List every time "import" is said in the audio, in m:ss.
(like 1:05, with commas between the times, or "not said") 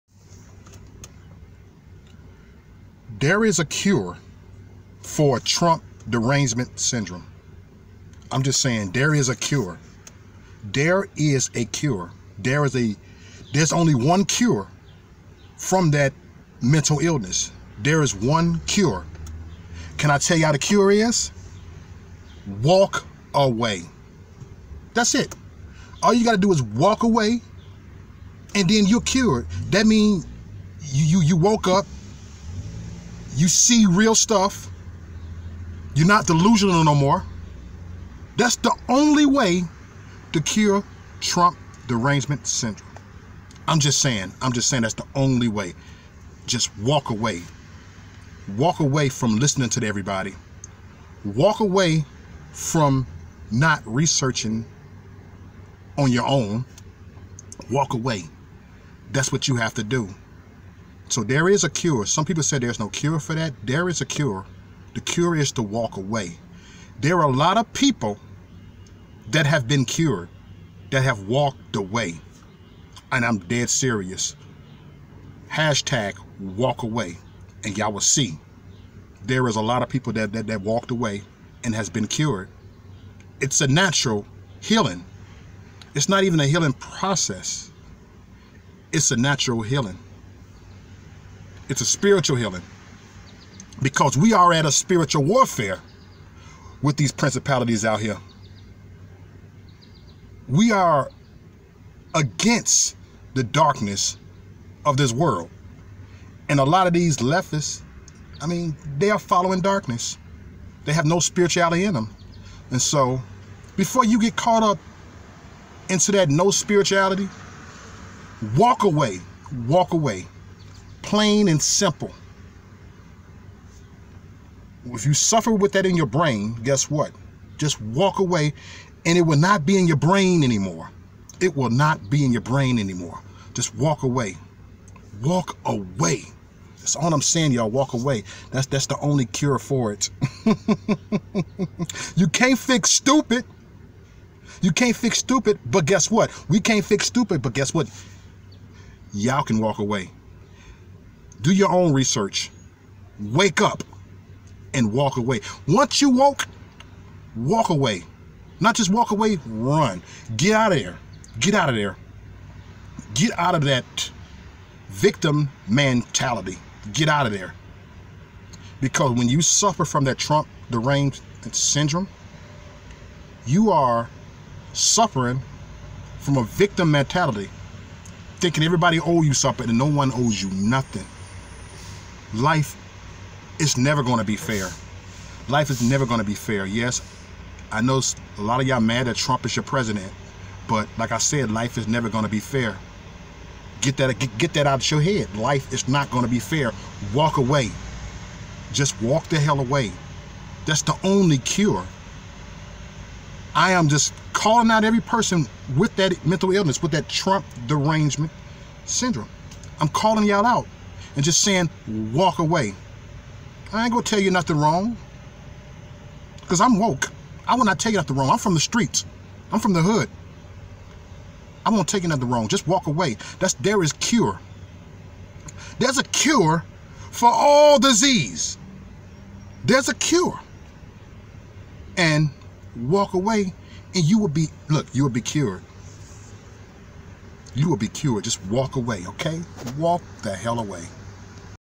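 not said.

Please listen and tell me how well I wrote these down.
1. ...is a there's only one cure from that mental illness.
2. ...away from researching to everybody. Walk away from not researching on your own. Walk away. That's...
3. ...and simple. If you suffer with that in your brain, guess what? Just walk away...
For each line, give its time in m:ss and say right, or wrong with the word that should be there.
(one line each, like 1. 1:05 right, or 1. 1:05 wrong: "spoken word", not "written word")
1. 0:12 right
2. 0:48 wrong: "listening", not "researching"
3. 2:01 right.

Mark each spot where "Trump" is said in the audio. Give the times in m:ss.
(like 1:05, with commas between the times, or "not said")
0:05, 0:41, 2:50, 3:09, 3:27.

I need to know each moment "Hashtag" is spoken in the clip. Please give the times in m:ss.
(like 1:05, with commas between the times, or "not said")
1:15.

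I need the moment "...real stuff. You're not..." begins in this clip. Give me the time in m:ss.
0:33.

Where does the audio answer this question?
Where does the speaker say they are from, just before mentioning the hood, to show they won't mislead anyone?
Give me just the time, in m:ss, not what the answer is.
3:38.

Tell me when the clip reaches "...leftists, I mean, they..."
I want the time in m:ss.
1:47.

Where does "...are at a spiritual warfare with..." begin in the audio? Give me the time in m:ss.
1:34.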